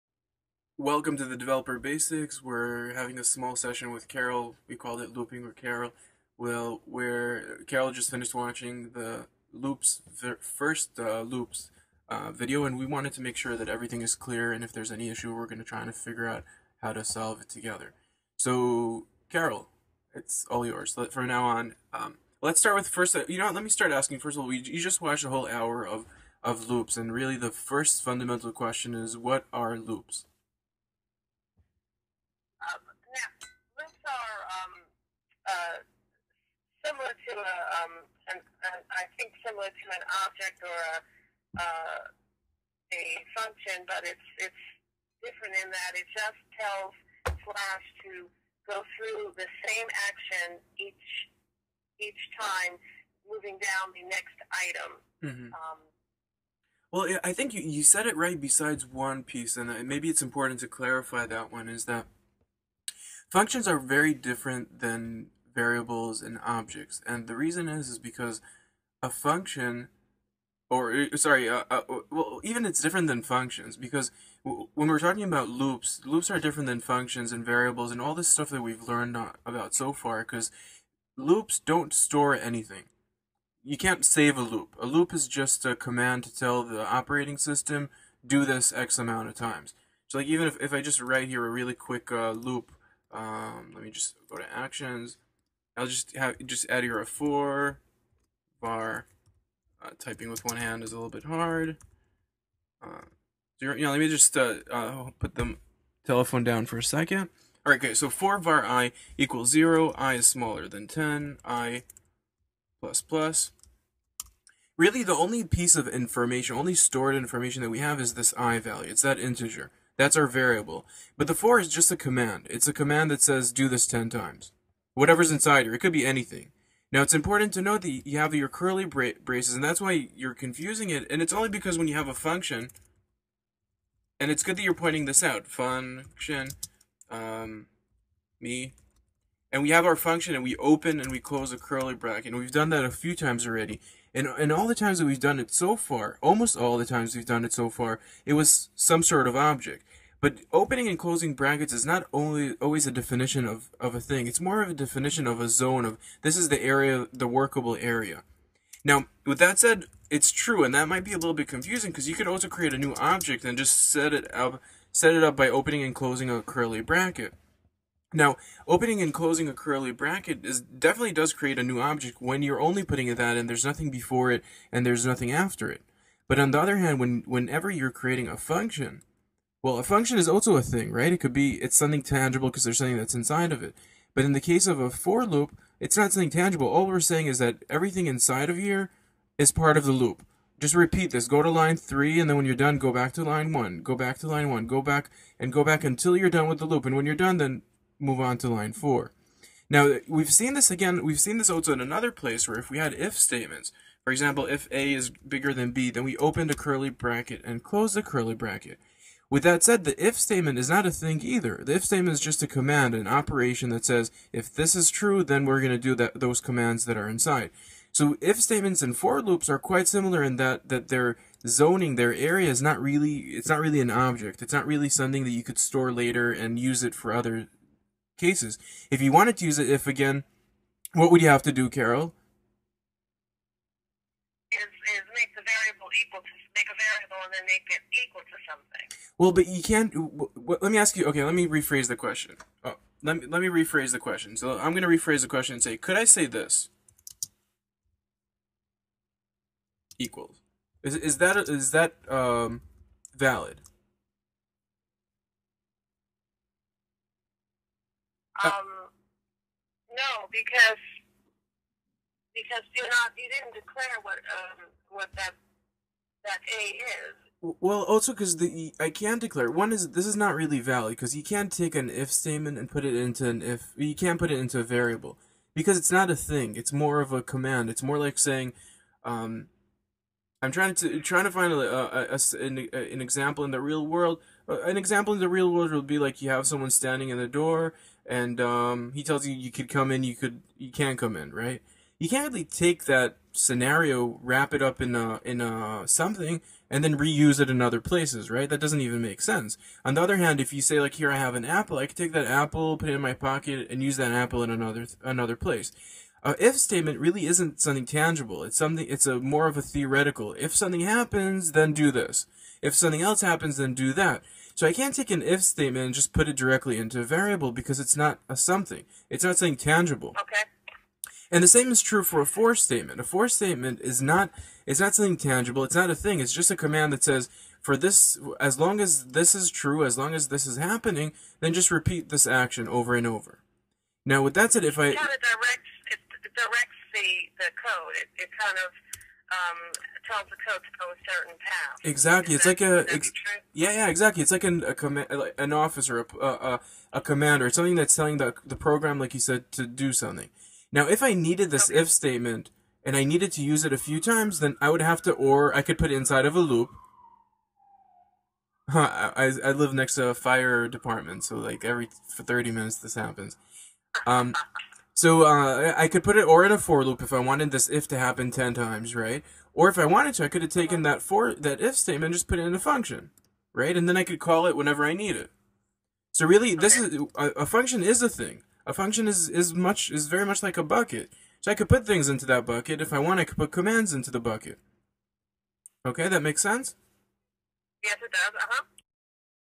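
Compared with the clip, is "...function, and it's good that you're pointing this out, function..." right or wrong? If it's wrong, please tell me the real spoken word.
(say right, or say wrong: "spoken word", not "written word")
right.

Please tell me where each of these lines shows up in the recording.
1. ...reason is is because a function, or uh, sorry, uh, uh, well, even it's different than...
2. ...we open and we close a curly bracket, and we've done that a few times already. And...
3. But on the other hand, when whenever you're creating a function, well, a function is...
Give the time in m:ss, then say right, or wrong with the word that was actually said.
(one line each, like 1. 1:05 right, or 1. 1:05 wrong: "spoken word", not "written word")
1. 1:07 right
2. 2:20 right
3. 2:56 right.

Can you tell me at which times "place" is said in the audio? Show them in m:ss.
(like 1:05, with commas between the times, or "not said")
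3:22, 4:57, 5:05.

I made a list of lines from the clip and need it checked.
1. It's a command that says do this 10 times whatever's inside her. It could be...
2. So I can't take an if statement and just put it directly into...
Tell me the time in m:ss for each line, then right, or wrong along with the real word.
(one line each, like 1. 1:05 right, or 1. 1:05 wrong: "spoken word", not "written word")
1. 2:02 right
2. 5:14 right.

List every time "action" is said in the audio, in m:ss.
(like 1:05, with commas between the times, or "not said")
0:50, 1:34, 5:32.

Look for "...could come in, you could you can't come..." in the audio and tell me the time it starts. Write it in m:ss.
4:49.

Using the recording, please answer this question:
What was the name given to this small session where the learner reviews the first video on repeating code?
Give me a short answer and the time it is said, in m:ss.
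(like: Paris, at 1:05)
Looping with Carole, at 0:05.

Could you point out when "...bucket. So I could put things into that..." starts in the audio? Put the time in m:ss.
6:20.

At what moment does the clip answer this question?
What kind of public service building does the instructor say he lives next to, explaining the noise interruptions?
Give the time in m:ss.
6:00.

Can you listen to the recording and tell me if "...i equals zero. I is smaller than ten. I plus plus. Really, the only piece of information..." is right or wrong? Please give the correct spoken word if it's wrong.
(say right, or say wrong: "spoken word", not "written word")
right.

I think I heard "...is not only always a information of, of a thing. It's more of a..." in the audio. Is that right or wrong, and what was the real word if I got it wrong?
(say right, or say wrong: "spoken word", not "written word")
wrong: "definition", not "information".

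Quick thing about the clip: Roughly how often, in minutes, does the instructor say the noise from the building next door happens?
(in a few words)
30.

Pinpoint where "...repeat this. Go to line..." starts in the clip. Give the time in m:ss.
3:10.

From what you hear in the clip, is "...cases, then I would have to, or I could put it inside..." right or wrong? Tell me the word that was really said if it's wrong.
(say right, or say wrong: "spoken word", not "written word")
wrong: "times", not "cases".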